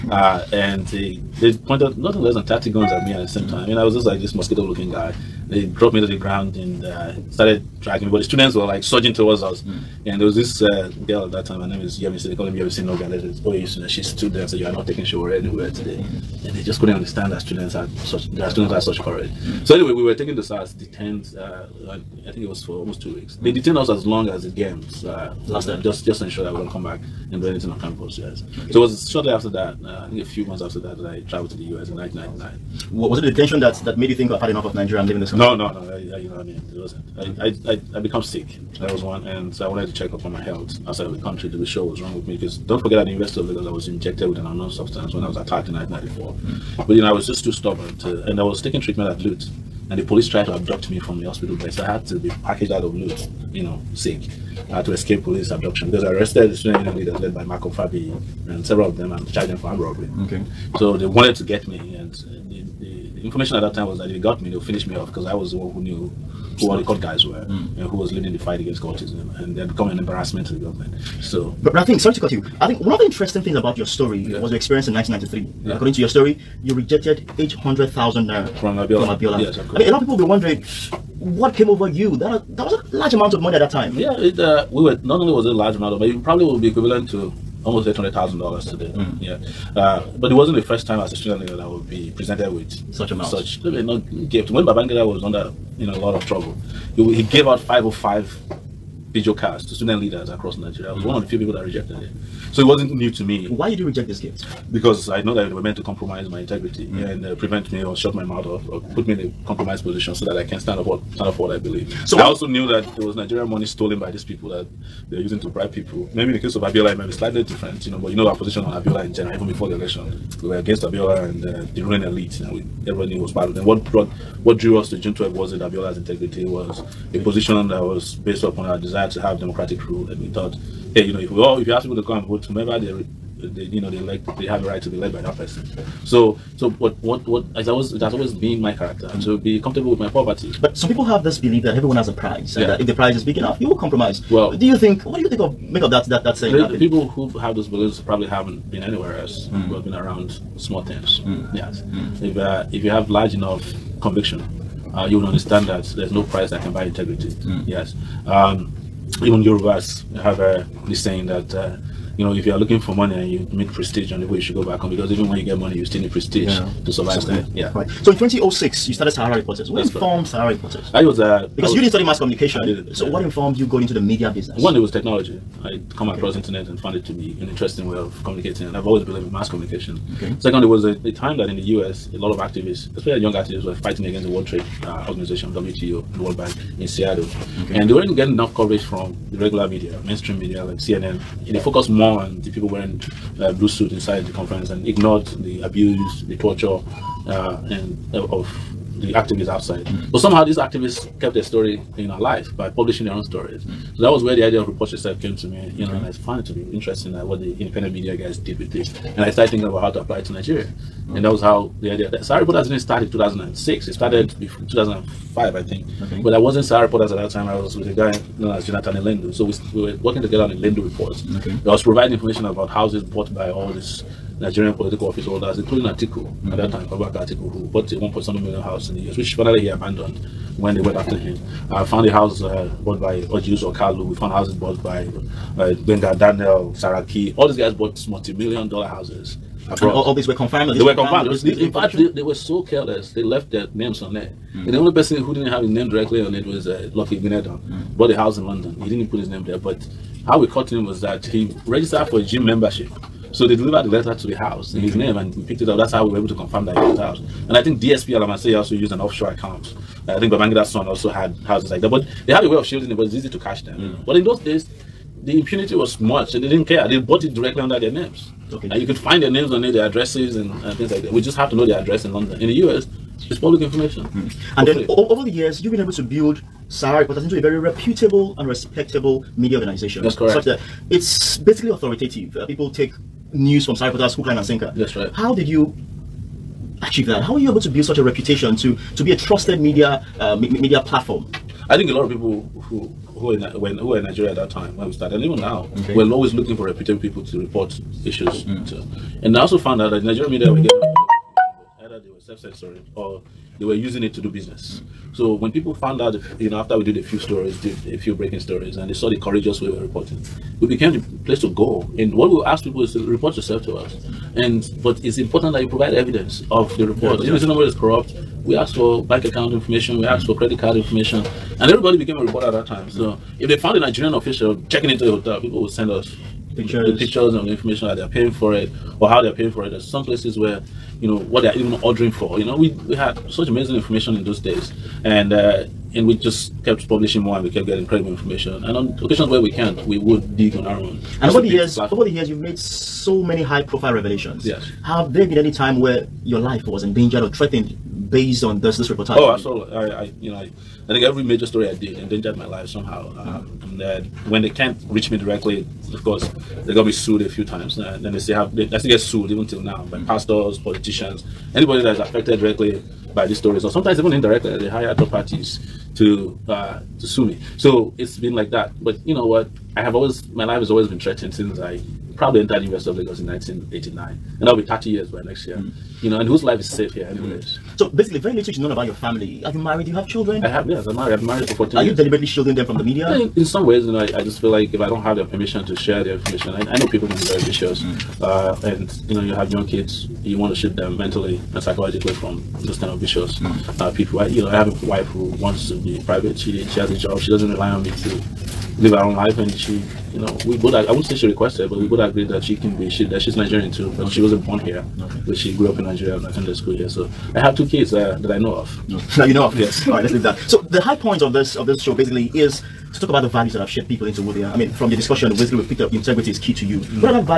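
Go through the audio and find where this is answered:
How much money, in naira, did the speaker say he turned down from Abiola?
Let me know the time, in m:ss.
1:17.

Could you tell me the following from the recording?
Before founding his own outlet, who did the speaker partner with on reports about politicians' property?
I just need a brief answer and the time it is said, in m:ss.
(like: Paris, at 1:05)
Jonathan Elendu, at 3:38.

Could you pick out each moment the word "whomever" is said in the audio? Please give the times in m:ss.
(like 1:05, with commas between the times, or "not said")
2:12.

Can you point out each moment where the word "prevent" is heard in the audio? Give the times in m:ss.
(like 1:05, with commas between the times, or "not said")
1:47.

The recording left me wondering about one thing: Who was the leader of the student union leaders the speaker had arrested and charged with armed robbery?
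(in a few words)
Malcolm Fabiyi.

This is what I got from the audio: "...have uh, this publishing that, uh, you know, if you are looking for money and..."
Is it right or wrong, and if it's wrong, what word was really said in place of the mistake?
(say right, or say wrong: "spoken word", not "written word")
wrong: "saying", not "publishing".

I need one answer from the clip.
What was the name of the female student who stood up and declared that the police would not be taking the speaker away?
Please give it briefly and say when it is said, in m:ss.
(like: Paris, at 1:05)
Yemi Sinoga, at 0:12.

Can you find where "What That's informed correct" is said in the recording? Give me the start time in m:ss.
2:49.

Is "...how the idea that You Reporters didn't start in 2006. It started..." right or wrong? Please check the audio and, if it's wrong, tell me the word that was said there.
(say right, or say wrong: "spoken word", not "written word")
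wrong: "Sahara", not "You".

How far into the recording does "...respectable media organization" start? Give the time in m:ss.
4:38.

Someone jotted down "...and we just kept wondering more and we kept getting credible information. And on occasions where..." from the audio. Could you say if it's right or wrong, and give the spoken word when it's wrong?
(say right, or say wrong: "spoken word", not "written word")
wrong: "publishing", not "wondering".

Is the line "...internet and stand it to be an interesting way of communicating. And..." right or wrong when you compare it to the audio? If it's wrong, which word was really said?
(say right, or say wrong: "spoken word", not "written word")
wrong: "found", not "stand".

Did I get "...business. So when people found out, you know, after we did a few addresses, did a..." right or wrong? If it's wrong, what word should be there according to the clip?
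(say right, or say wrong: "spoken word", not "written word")
wrong: "stories", not "addresses".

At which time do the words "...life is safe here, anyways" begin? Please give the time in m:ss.
6:16.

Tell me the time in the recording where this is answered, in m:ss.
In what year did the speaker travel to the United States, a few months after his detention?
0:31.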